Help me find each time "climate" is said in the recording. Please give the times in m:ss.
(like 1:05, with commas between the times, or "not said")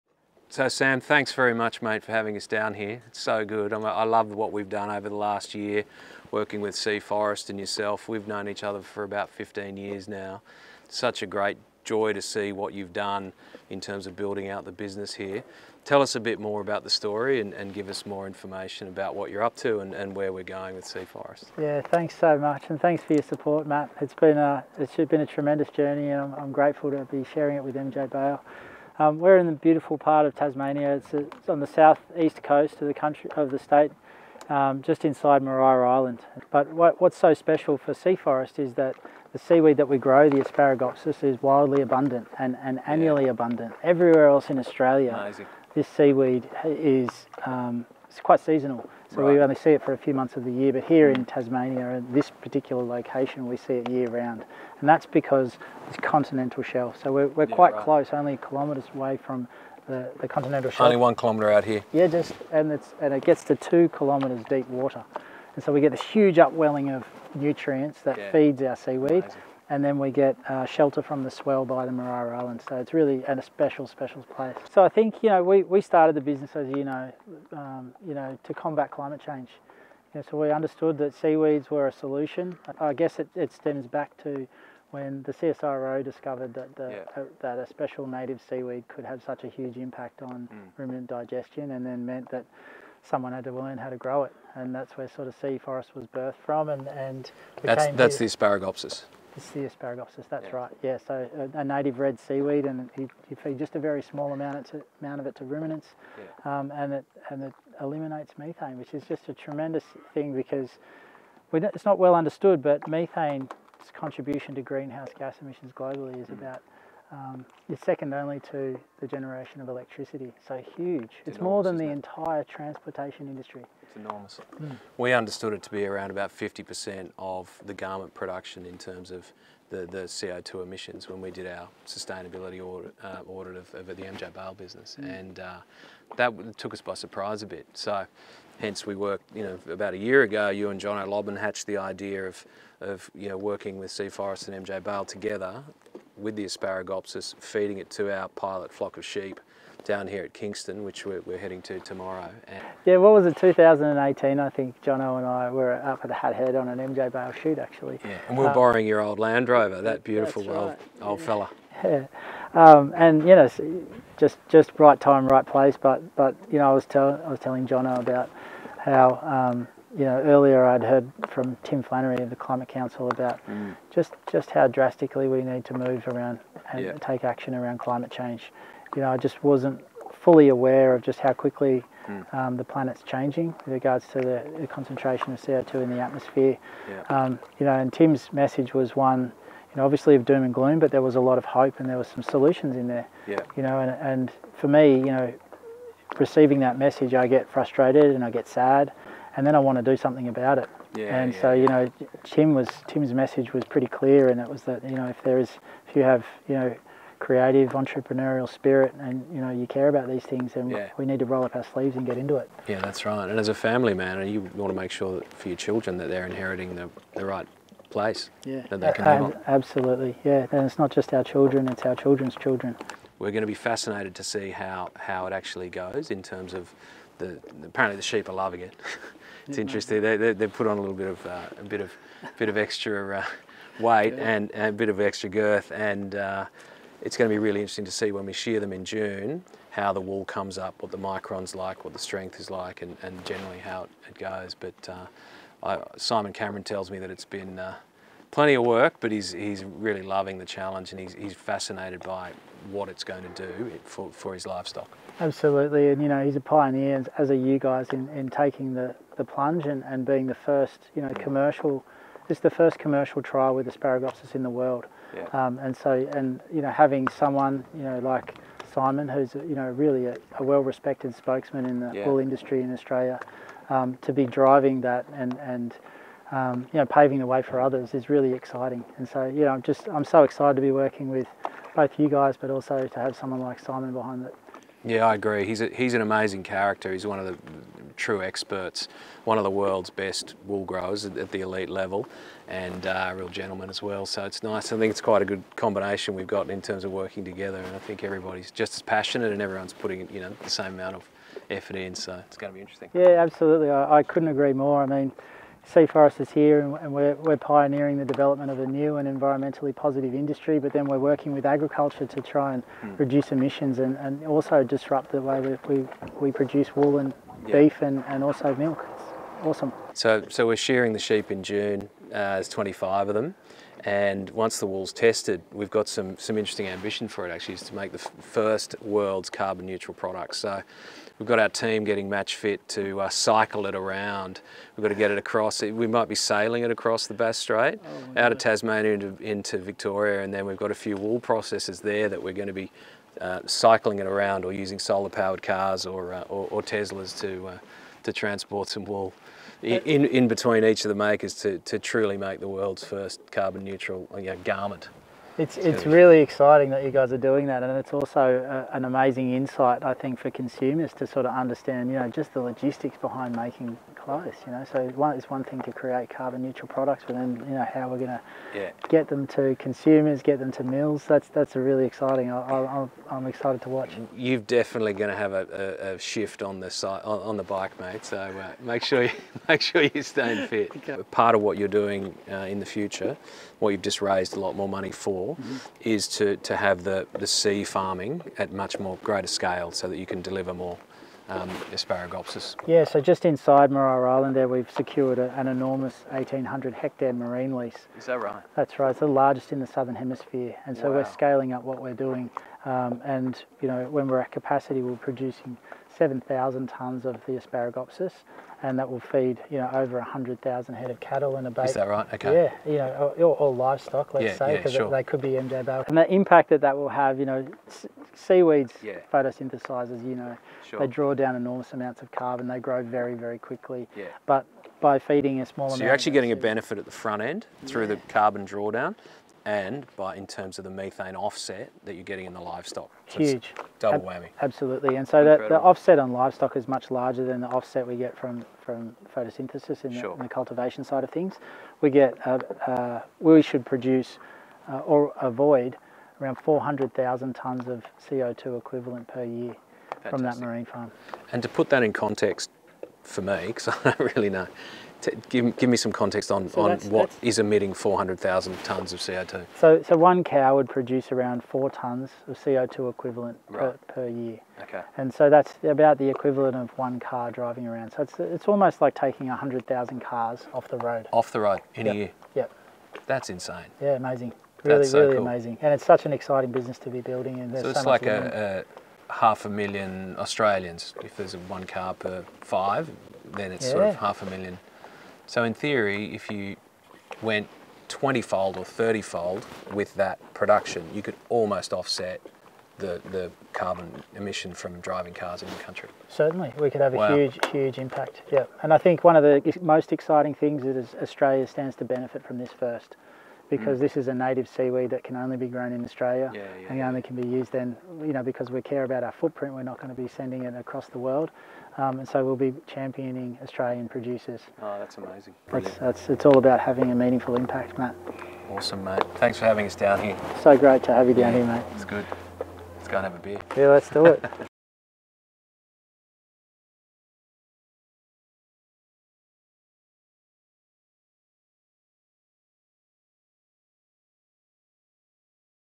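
1:18, 2:52, 2:57.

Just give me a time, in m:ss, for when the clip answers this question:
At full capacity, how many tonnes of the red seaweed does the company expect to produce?
6:46.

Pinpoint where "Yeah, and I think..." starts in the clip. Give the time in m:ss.
8:18.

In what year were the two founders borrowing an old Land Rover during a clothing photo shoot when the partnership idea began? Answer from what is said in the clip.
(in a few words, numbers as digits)
2018.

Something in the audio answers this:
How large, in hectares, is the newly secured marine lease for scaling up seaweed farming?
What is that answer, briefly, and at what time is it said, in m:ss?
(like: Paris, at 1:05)
1,800 hectares, at 6:36.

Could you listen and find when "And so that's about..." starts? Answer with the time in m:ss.
7:44.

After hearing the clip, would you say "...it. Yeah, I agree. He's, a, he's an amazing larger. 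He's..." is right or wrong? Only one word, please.
wrong.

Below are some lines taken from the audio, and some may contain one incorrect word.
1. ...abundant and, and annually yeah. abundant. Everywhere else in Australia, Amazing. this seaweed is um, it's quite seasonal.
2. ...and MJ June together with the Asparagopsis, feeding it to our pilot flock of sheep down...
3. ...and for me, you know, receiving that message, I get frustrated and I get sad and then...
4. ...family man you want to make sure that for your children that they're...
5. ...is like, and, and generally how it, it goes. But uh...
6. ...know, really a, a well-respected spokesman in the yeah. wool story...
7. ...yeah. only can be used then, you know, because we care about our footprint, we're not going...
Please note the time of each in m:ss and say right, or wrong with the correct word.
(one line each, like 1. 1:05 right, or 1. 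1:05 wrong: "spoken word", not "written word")
1. 0:41 right
2. 2:24 wrong: "Bale", not "June"
3. 3:13 right
4. 3:33 right
5. 4:02 right
6. 4:29 wrong: "industry", not "story"
7. 8:26 right.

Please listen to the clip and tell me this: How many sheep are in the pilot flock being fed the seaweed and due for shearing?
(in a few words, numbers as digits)
25.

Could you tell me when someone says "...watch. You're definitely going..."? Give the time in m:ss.
6:13.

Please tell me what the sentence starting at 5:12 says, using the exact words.
reduce emissions and, and also disrupt the way we, we, we produce wool and yeah.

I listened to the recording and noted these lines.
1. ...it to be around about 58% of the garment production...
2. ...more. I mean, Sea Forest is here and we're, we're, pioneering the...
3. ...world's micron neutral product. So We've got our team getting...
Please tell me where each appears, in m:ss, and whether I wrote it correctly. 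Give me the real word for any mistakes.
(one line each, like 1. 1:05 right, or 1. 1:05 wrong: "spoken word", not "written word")
1. 2:05 wrong: "50", not "58"
2. 5:04 right
3. 5:28 wrong: "carbon", not "micron".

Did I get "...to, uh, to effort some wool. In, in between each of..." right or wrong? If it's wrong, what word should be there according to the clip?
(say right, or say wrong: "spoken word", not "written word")
wrong: "transport", not "effort".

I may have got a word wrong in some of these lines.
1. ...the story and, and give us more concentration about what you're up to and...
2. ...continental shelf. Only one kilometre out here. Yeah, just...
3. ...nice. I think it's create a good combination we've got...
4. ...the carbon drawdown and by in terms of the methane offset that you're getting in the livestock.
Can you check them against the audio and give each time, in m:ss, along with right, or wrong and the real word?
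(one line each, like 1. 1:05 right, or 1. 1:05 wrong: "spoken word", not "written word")
1. 0:16 wrong: "information", not "concentration"
2. 1:00 right
3. 4:54 wrong: "quite", not "create"
4. 7:07 right.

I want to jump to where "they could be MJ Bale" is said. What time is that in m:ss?
6:54.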